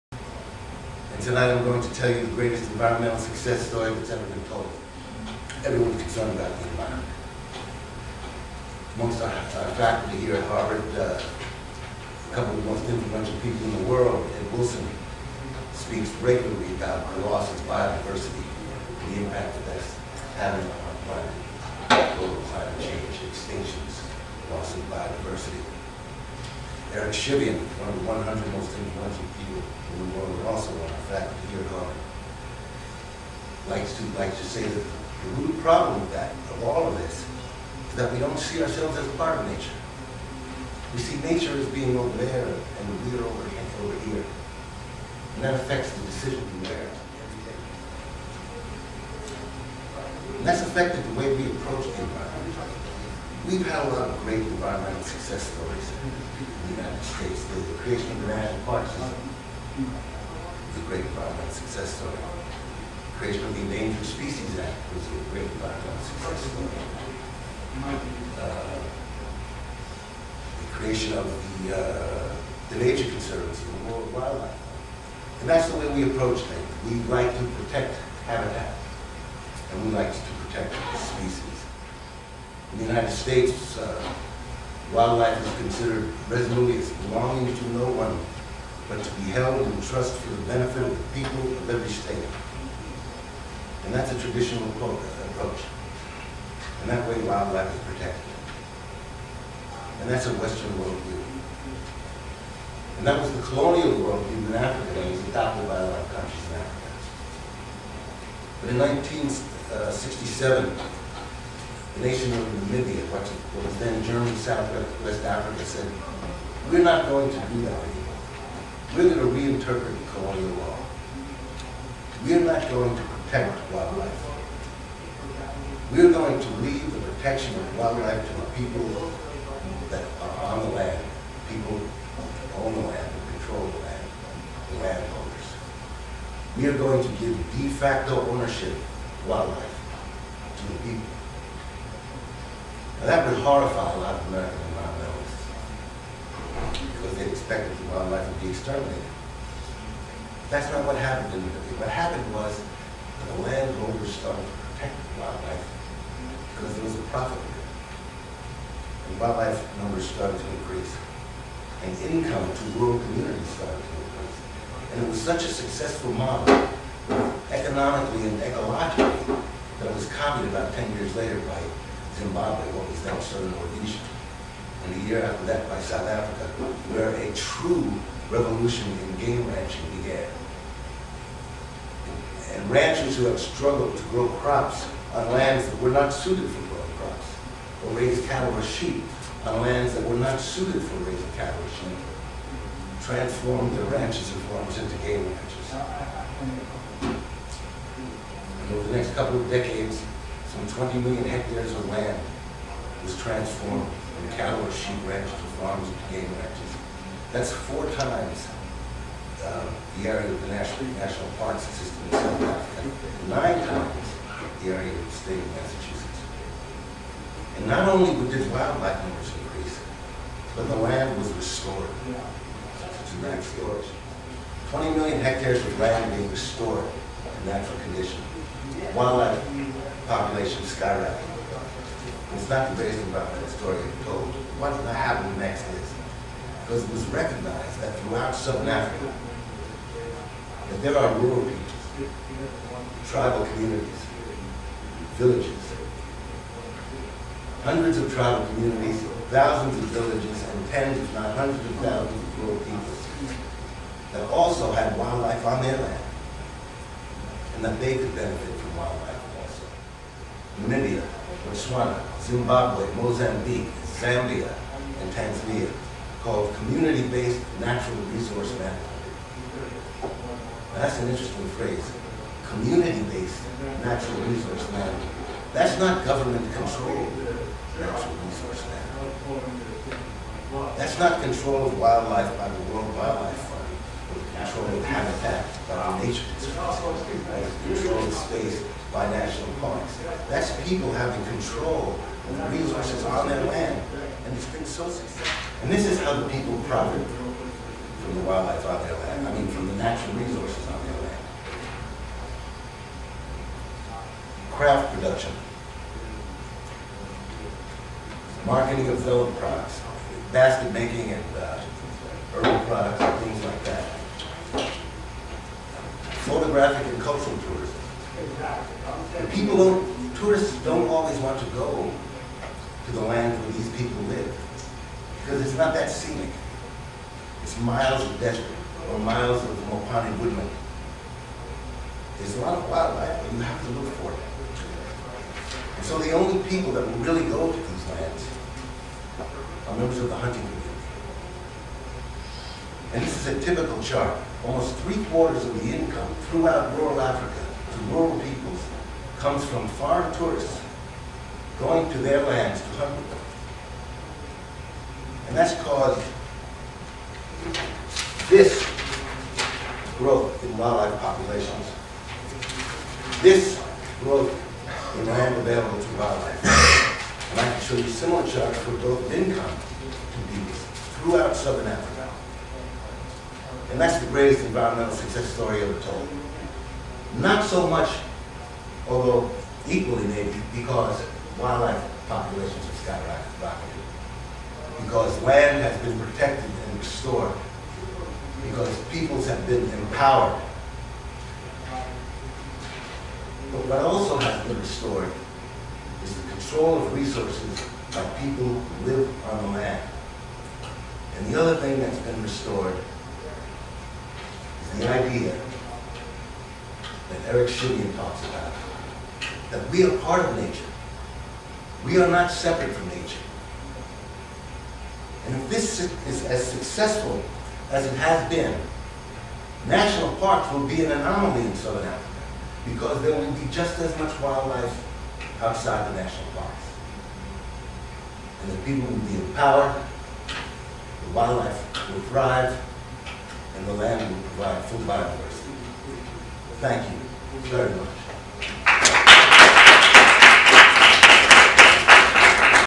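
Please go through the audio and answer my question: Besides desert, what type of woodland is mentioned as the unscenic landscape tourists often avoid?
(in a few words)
Mopani woodland.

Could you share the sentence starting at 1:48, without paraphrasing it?
But in 1967, nation of Namibia, what was then German Southwest Africa, said, we're not going to do that anymore.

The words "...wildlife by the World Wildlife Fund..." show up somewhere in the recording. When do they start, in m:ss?
4:41.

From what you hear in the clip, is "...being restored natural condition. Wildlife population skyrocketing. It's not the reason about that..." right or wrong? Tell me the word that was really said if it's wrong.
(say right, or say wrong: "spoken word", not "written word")
right.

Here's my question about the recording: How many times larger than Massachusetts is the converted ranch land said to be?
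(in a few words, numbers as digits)
9.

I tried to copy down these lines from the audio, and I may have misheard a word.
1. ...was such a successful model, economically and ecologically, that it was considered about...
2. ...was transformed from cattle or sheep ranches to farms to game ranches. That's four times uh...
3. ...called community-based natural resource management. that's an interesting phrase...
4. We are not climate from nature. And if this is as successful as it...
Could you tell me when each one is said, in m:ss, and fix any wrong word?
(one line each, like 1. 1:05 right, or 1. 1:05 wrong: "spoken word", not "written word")
1. 2:45 wrong: "copied", not "considered"
2. 3:23 right
3. 4:26 right
4. 6:51 wrong: "separate", not "climate".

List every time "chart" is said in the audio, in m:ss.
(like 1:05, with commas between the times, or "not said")
5:43, 6:08.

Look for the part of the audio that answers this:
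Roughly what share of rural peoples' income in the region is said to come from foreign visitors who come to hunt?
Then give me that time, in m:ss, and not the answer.
5:44.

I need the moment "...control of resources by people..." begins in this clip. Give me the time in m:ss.
6:36.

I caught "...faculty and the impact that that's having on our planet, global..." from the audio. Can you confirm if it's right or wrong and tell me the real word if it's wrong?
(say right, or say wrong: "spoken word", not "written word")
wrong: "biodiversity", not "faculty".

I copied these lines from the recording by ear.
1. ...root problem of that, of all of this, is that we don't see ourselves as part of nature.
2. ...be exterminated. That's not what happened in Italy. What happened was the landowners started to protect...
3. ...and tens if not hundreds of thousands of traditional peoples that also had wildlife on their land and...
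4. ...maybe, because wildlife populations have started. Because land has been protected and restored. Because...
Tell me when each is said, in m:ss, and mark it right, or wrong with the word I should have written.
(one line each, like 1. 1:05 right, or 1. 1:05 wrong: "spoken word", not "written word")
1. 0:35 right
2. 2:28 right
3. 4:10 wrong: "rural", not "traditional"
4. 6:20 wrong: "skyrocketed", not "started".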